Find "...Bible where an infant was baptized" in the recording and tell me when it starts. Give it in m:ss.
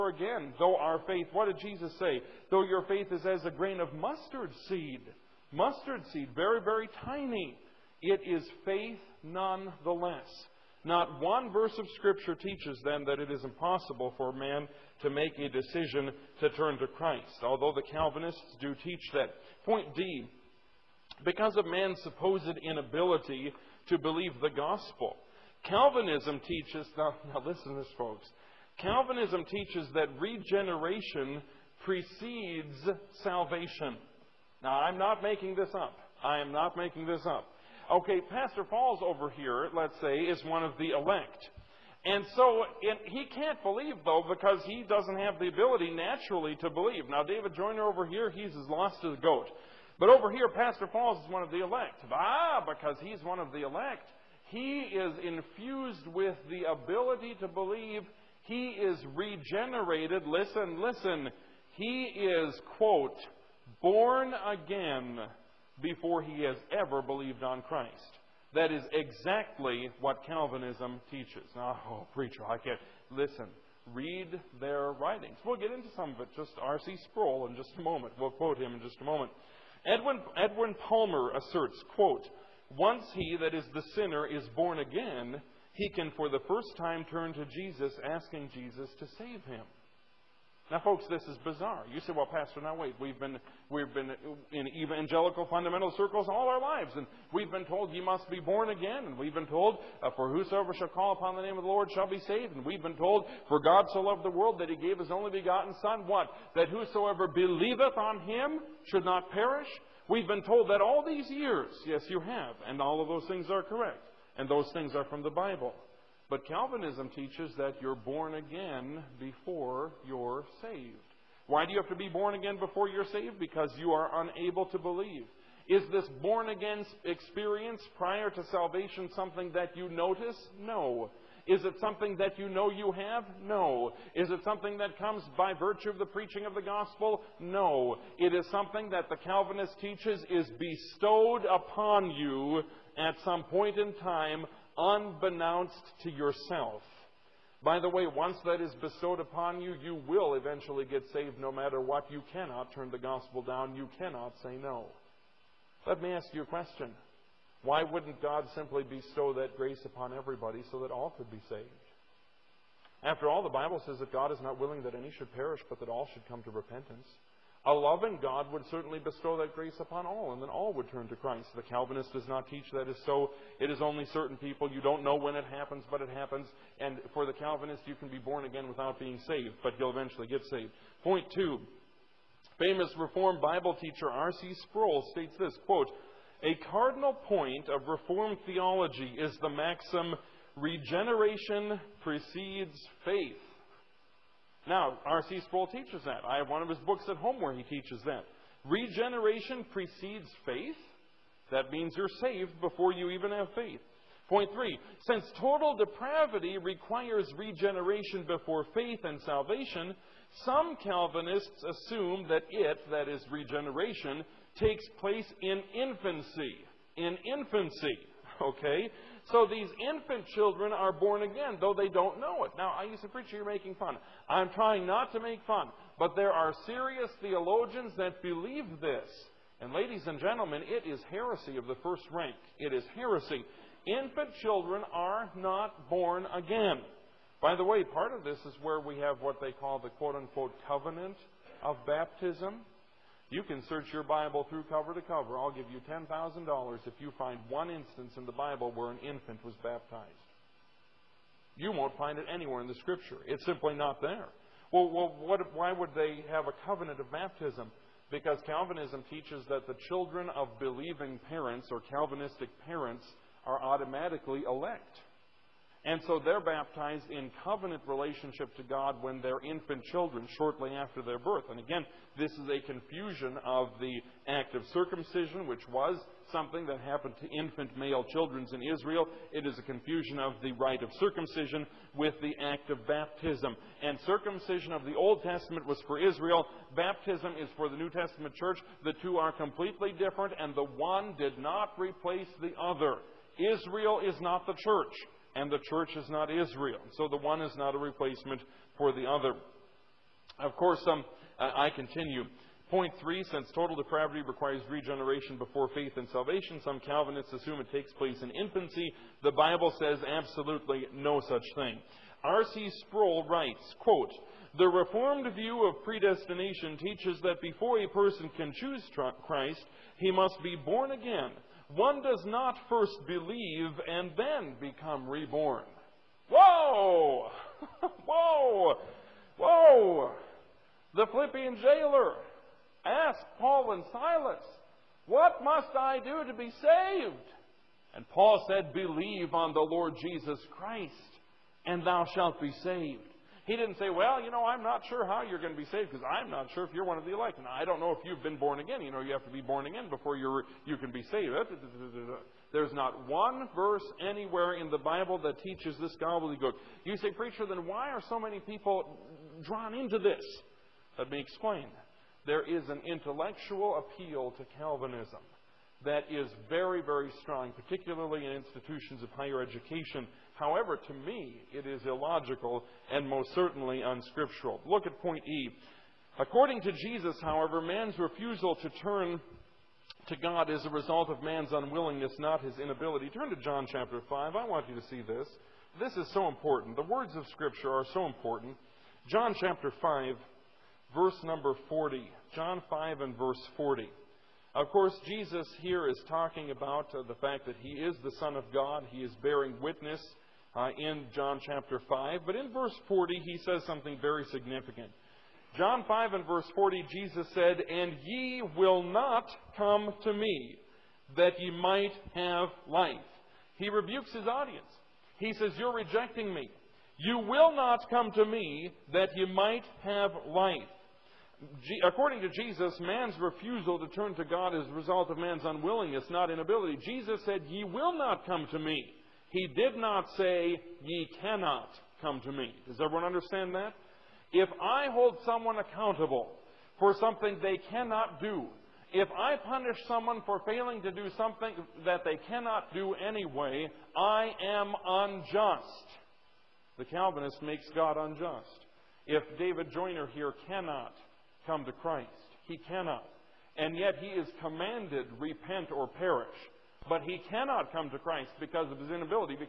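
4:08.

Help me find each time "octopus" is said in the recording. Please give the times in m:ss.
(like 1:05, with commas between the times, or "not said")
not said.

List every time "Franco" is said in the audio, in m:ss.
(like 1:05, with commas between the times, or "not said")
not said.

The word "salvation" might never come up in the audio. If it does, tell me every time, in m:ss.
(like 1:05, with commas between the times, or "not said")
0:33, 2:08, 3:29, 5:06.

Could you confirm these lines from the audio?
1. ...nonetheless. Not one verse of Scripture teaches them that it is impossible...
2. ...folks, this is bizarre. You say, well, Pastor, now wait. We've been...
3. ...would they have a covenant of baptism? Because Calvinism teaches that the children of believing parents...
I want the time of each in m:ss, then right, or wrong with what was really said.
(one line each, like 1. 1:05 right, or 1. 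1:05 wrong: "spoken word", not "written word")
1. 0:09 right
2. 1:30 right
3. 4:15 right.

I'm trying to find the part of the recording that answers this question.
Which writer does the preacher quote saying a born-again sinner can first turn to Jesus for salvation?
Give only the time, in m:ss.
1:20.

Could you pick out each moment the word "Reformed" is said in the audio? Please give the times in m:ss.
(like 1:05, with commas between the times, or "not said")
3:02, 3:07, 5:14.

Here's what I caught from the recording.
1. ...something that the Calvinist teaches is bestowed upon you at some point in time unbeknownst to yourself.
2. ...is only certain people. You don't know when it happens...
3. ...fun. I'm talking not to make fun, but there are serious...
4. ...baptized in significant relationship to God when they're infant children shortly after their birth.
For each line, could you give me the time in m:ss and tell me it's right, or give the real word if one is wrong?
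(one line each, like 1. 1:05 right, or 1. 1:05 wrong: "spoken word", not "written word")
1. 2:18 right
2. 2:53 right
3. 3:43 wrong: "trying", not "talking"
4. 4:26 wrong: "covenant", not "significant".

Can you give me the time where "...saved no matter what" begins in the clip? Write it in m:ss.
2:31.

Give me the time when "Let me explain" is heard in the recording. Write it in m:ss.
6:00.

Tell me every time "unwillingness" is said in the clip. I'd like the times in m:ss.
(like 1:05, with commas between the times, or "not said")
6:21, 7:05.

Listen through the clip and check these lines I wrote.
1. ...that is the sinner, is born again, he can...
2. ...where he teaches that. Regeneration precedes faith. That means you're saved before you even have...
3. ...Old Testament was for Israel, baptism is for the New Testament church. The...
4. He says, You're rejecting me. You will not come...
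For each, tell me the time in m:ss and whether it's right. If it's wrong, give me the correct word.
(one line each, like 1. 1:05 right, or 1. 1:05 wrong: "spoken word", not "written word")
1. 1:23 right
2. 3:17 right
3. 4:44 right
4. 6:55 right.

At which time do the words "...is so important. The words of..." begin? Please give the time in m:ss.
6:25.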